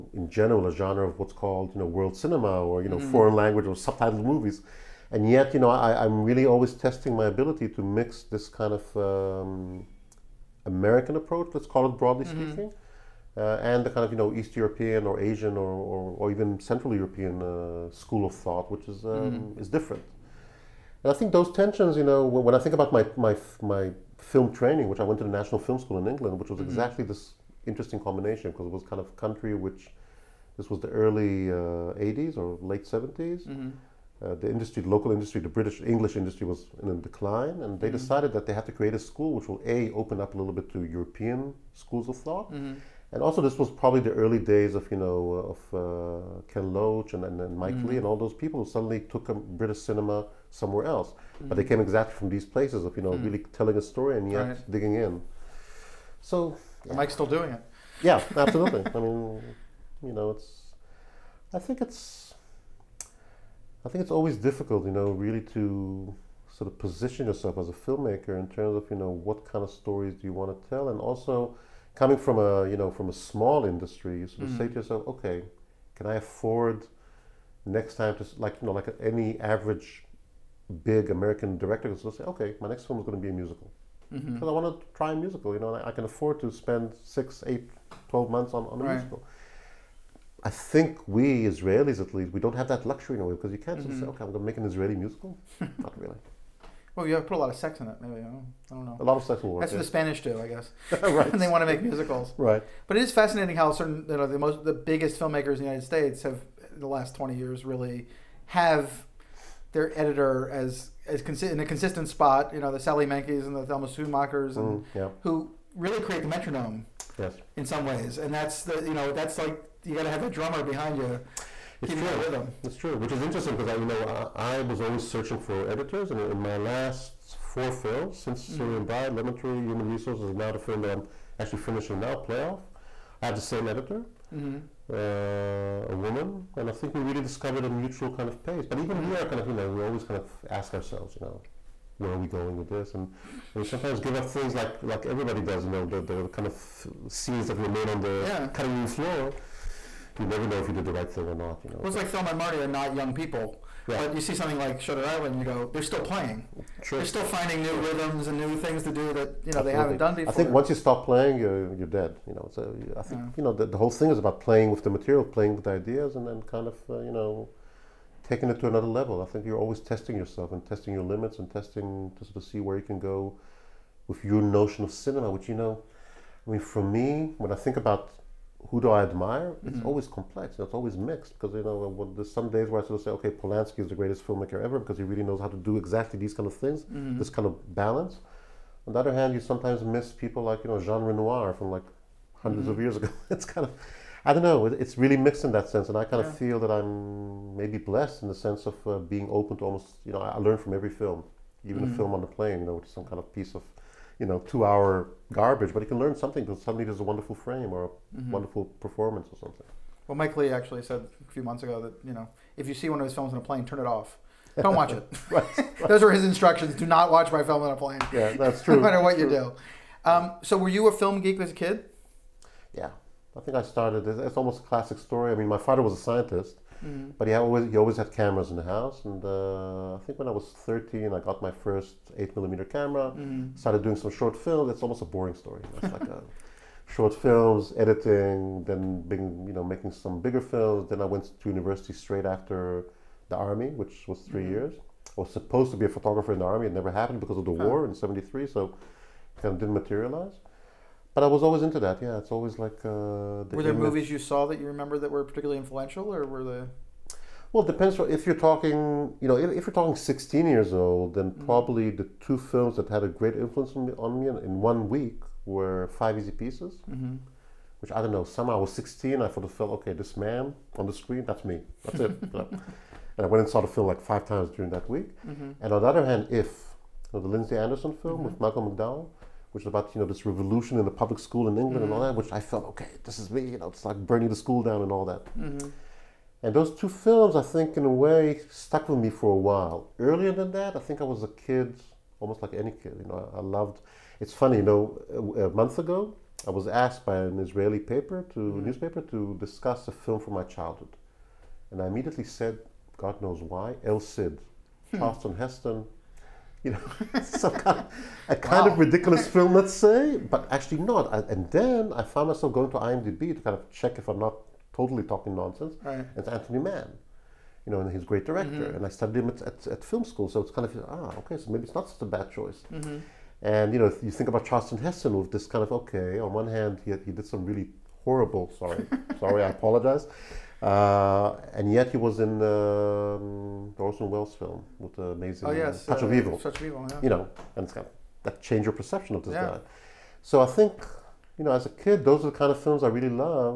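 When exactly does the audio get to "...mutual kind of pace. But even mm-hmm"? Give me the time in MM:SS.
02:17.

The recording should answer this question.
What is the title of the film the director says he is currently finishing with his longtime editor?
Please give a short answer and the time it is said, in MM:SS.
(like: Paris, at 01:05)
Playoff, at 02:12.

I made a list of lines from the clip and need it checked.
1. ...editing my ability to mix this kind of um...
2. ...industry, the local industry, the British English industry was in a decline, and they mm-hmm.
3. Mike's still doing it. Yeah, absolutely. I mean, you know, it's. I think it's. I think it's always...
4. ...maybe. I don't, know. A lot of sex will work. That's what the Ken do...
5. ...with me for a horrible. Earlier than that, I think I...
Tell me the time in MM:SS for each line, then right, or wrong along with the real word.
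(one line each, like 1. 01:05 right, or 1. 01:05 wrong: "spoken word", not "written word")
1. 00:06 wrong: "testing", not "editing"
2. 00:34 right
3. 00:56 right
4. 01:38 wrong: "Spanish", not "Ken"
5. 04:48 wrong: "while", not "horrible".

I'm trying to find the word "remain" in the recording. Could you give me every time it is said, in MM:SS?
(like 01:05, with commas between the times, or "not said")
02:27.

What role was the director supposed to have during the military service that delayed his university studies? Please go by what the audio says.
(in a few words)
Photographer.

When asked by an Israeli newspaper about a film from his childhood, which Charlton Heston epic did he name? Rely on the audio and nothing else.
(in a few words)
El Cid.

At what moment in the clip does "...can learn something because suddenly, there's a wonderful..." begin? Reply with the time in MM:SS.
03:25.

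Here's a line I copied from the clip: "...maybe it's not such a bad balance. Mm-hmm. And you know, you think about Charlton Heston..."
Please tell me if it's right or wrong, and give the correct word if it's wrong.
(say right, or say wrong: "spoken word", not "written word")
wrong: "choice", not "balance".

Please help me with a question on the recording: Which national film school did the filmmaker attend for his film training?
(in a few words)
National Film School in England.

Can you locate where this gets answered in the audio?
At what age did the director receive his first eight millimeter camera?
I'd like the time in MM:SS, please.
03:50.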